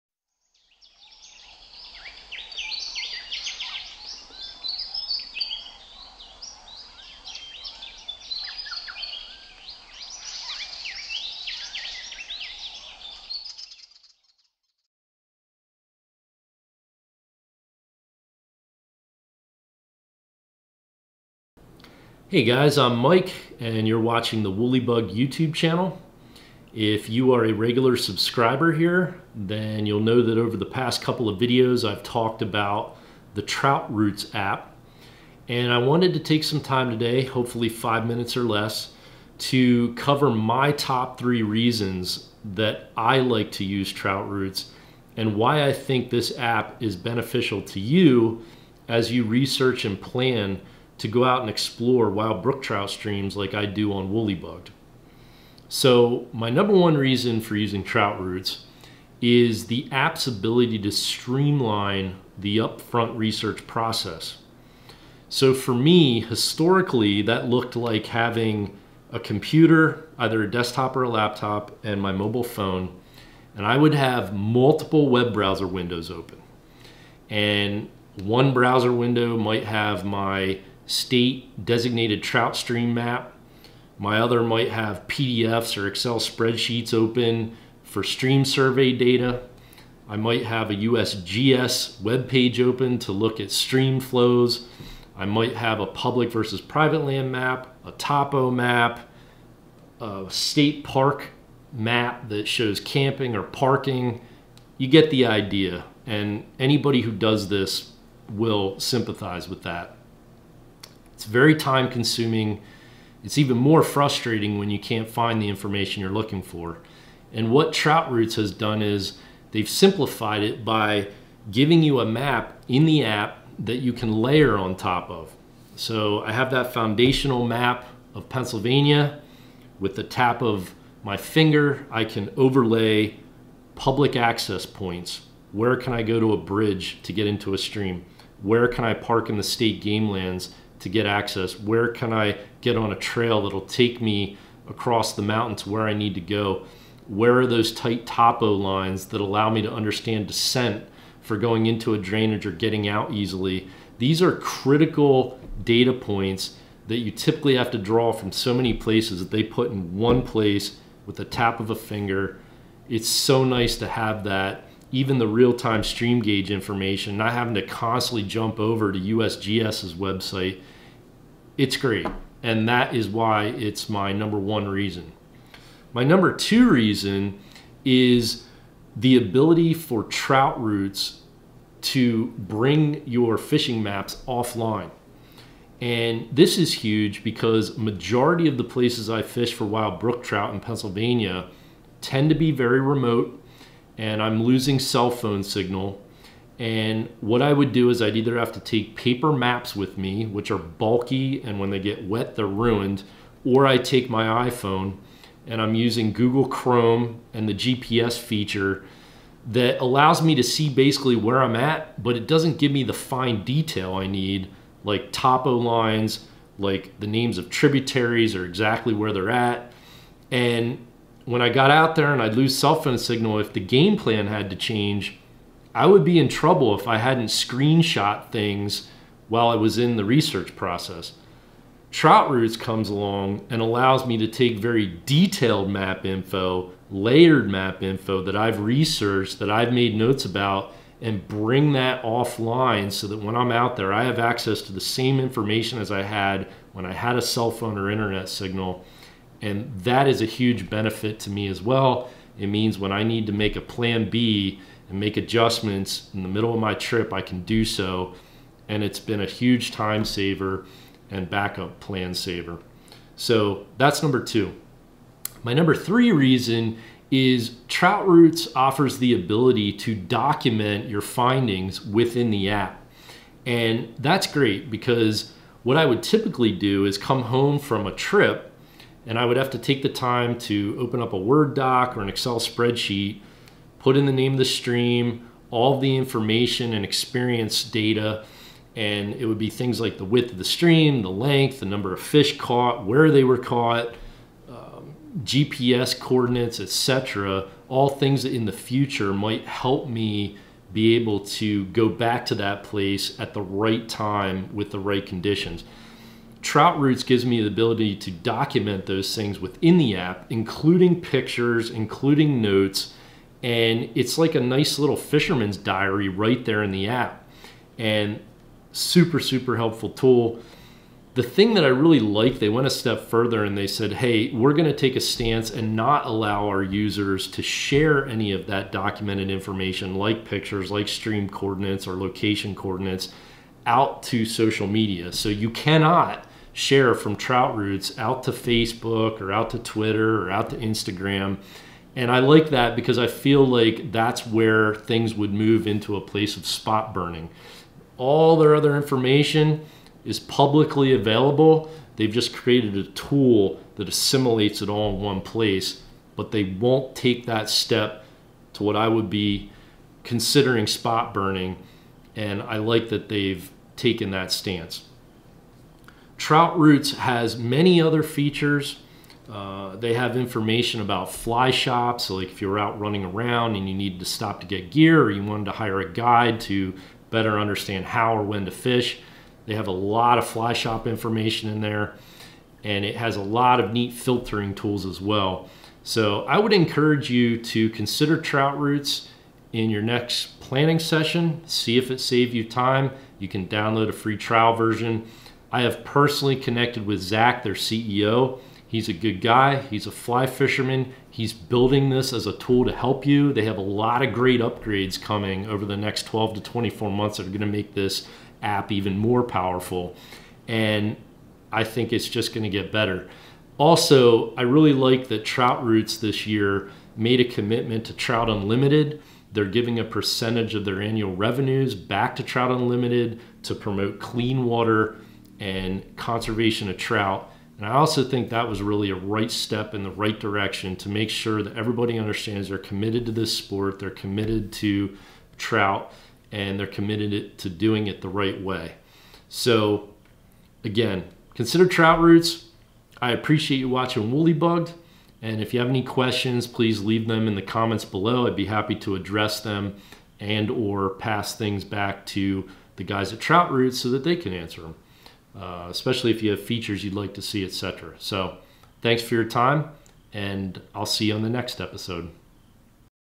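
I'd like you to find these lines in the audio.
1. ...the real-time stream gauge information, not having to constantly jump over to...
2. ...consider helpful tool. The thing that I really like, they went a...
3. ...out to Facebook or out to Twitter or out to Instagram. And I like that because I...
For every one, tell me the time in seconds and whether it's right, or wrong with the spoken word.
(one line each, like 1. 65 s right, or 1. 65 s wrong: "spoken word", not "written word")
1. 165 s right
2. 319 s wrong: "super", not "consider"
3. 337 s right.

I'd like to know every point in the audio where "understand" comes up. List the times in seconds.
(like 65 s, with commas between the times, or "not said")
149 s, 377 s, 431 s.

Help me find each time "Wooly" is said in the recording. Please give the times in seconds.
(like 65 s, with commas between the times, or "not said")
24 s, 54 s, 444 s.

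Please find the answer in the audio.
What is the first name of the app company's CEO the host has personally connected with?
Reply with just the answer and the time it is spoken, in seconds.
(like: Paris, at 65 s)
Zach, at 397 s.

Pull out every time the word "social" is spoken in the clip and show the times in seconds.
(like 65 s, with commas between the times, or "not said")
334 s.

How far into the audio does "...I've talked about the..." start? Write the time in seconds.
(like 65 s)
31 s.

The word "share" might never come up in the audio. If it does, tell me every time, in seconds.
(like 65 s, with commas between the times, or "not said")
327 s, 336 s.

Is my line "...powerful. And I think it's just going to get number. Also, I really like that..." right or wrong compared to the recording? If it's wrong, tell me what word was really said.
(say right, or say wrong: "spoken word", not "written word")
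wrong: "better", not "number".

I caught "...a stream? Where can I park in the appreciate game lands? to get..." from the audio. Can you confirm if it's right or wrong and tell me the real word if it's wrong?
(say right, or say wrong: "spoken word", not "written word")
wrong: "state", not "appreciate".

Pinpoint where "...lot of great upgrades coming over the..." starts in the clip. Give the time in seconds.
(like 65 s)
403 s.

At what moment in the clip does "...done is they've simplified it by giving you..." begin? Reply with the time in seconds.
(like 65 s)
118 s.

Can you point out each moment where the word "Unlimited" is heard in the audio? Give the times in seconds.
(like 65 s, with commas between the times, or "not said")
418 s, 422 s.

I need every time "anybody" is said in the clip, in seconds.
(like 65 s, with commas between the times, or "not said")
106 s.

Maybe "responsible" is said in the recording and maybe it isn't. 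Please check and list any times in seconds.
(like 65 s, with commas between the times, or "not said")
not said.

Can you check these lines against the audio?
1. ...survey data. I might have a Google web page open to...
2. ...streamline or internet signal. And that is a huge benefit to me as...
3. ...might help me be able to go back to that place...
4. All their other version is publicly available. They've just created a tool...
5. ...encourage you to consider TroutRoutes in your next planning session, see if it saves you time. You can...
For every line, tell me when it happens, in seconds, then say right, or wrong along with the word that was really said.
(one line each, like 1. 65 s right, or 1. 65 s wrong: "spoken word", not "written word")
1. 88 s wrong: "USGS", not "Google"
2. 247 s wrong: "phone", not "streamline"
3. 299 s right
4. 347 s wrong: "information", not "version"
5. 386 s right.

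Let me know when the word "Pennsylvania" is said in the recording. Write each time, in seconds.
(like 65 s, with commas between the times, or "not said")
128 s, 190 s.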